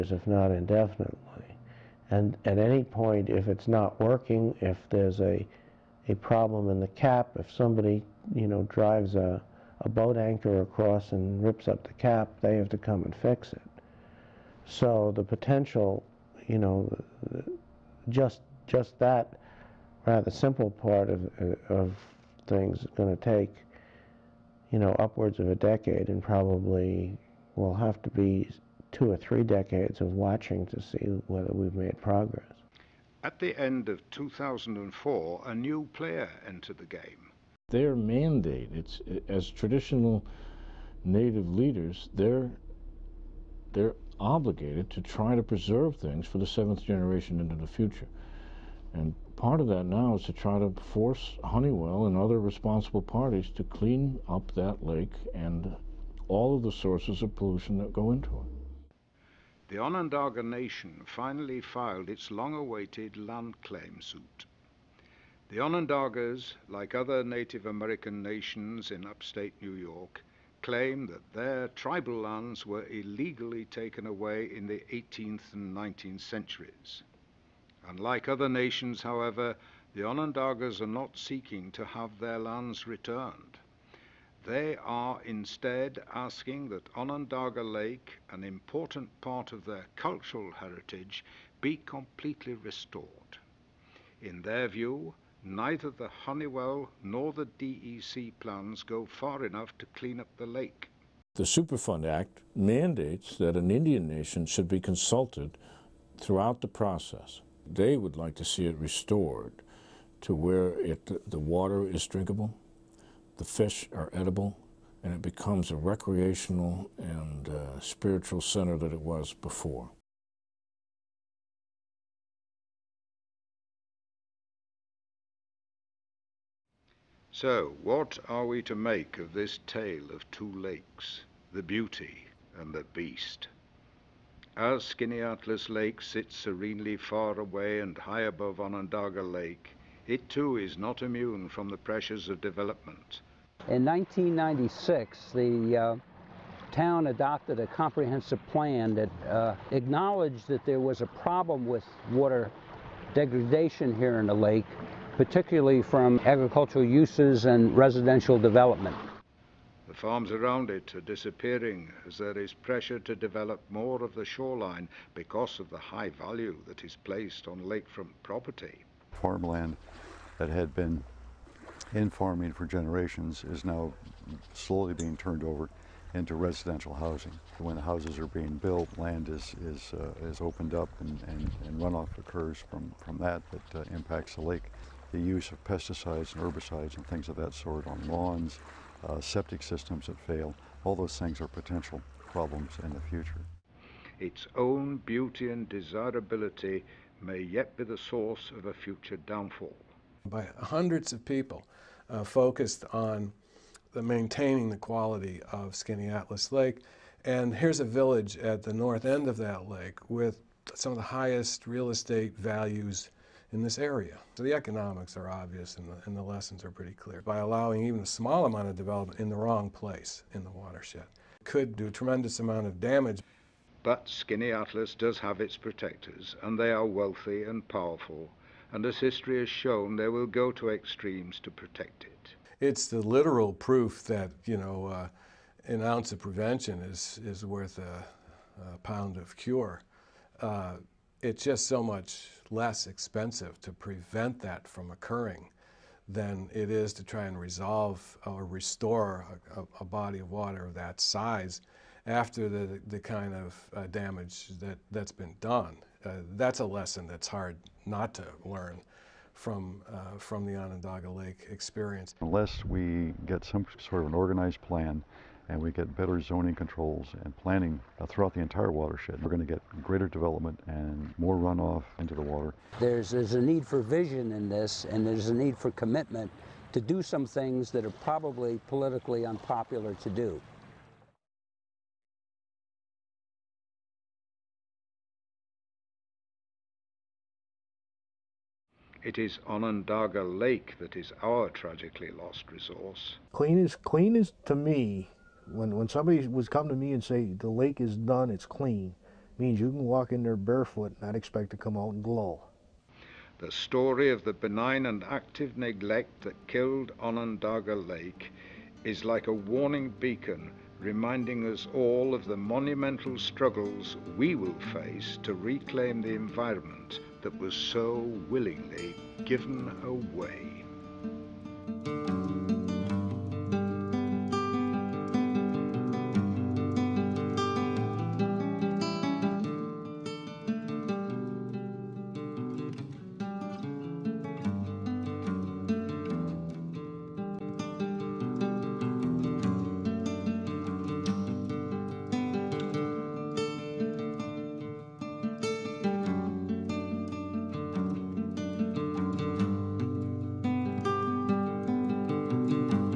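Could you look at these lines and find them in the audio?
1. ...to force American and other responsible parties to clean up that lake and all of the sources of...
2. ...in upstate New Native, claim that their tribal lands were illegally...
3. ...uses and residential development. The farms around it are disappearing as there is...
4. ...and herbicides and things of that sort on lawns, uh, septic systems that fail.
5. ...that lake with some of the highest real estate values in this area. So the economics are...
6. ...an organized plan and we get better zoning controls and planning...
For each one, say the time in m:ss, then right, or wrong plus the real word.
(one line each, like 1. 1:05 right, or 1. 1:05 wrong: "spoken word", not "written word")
1. 0:50 wrong: "Honeywell", not "American"
2. 1:08 wrong: "York", not "Native"
3. 2:36 right
4. 3:06 right
5. 3:29 right
6. 4:24 right.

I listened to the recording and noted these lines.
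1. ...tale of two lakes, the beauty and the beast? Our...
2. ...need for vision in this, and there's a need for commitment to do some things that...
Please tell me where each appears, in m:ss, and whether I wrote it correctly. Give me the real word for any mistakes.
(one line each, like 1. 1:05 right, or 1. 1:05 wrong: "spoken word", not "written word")
1. 2:09 right
2. 4:33 right.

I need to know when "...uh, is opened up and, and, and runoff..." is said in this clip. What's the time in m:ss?
2:59.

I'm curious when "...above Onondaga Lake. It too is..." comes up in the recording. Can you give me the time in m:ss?
2:18.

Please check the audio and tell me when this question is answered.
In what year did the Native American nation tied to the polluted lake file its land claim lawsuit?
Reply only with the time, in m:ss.
0:34.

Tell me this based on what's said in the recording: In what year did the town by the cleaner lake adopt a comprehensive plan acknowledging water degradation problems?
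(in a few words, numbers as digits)
1996.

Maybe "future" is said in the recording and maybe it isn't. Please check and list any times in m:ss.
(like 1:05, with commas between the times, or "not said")
0:47, 3:13, 3:18.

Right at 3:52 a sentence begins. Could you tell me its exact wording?
It's the literal proof that, you know, uh, an ounce of prevention is, is worth a, a pound of cure.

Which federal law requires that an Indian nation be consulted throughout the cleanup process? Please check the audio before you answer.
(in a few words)
Superfund Act.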